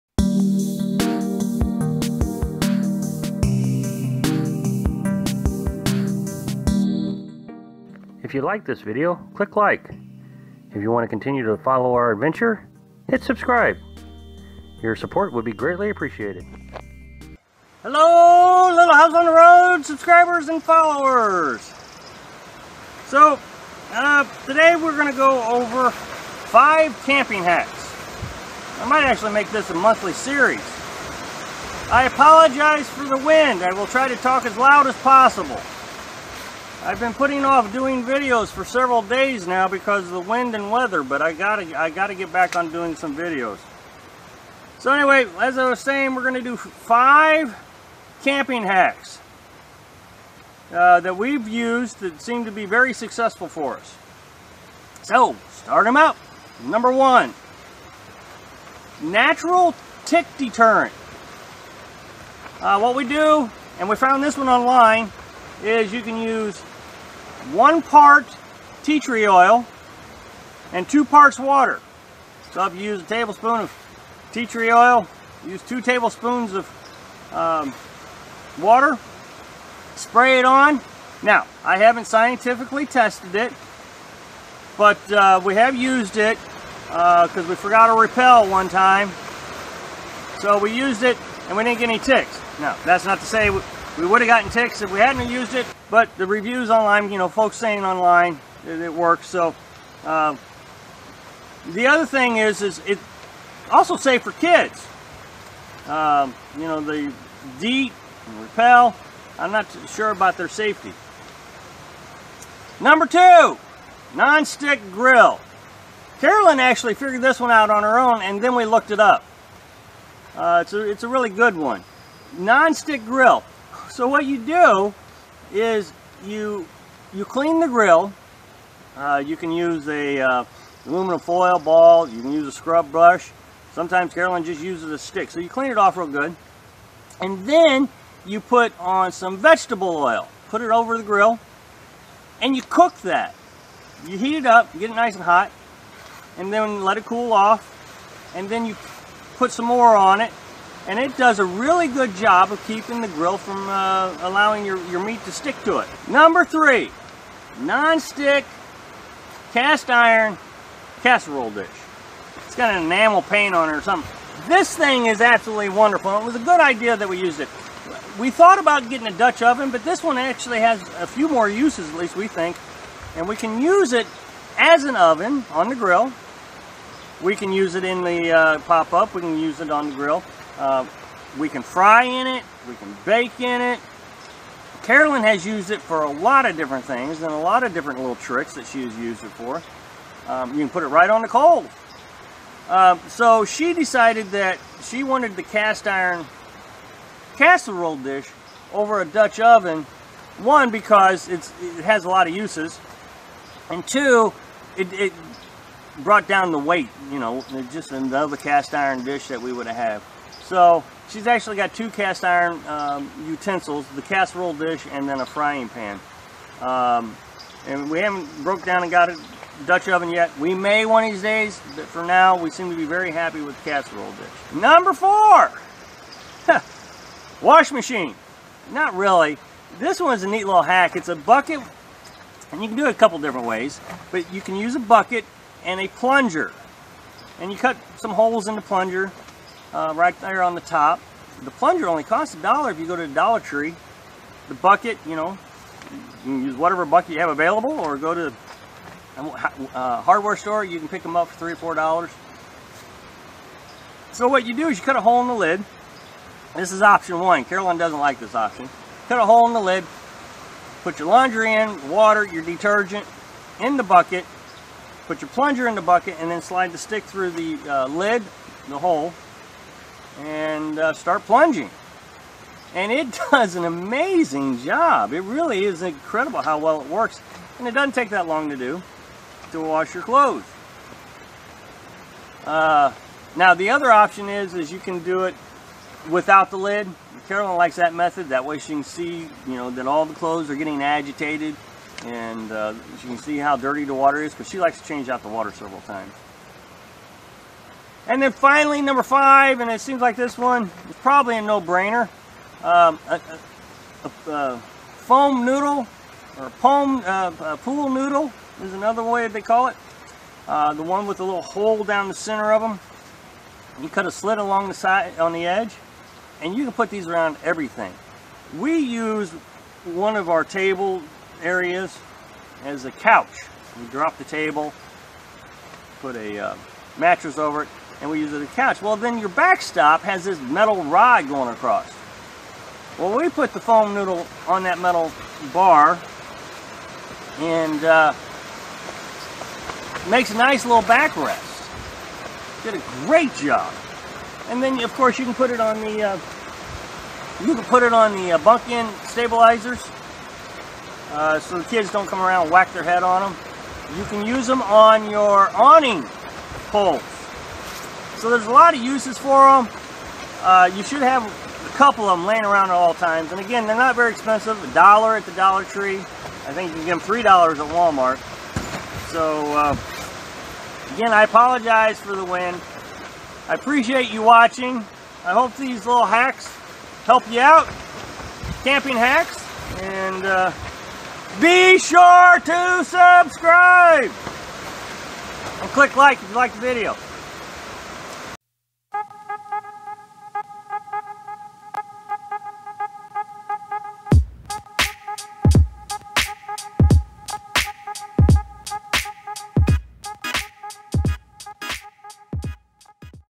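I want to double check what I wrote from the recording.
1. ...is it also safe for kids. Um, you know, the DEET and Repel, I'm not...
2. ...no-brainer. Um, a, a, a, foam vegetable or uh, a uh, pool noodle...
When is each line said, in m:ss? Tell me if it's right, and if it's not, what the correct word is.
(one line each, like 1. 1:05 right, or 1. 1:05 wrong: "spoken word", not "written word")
1. 1:42 right
2. 5:01 wrong: "noodle", not "vegetable".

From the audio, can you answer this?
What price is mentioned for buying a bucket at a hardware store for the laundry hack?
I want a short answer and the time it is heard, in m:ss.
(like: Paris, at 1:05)
3 or 4 dollars, at 4:11.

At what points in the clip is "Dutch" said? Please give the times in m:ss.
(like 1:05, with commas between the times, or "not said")
2:49, 3:19, 3:39.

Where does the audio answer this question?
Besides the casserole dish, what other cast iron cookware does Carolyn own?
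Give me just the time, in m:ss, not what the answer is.
3:35.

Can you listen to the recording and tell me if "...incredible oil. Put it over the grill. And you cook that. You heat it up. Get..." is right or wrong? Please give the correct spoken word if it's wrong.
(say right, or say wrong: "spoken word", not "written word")
wrong: "vegetable", not "incredible".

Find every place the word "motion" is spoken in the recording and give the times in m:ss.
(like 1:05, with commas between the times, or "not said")
not said.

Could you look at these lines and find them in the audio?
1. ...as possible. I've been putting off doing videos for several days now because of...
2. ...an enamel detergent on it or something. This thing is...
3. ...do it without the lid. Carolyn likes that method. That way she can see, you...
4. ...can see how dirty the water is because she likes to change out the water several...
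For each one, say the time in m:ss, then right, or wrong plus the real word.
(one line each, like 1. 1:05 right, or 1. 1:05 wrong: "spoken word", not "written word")
1. 0:34 right
2. 2:42 wrong: "paint", not "detergent"
3. 4:45 right
4. 4:53 right.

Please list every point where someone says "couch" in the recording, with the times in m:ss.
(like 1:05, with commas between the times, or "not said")
5:22, 5:28.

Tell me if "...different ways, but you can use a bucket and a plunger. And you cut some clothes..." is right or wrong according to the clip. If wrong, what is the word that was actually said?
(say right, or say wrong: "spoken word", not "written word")
wrong: "holes", not "clothes".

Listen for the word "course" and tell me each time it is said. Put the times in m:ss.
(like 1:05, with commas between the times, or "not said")
5:44.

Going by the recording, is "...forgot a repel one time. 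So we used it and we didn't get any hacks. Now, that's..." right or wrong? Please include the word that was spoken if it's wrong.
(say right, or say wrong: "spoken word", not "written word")
wrong: "ticks", not "hacks".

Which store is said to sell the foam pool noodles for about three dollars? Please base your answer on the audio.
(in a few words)
Walmart.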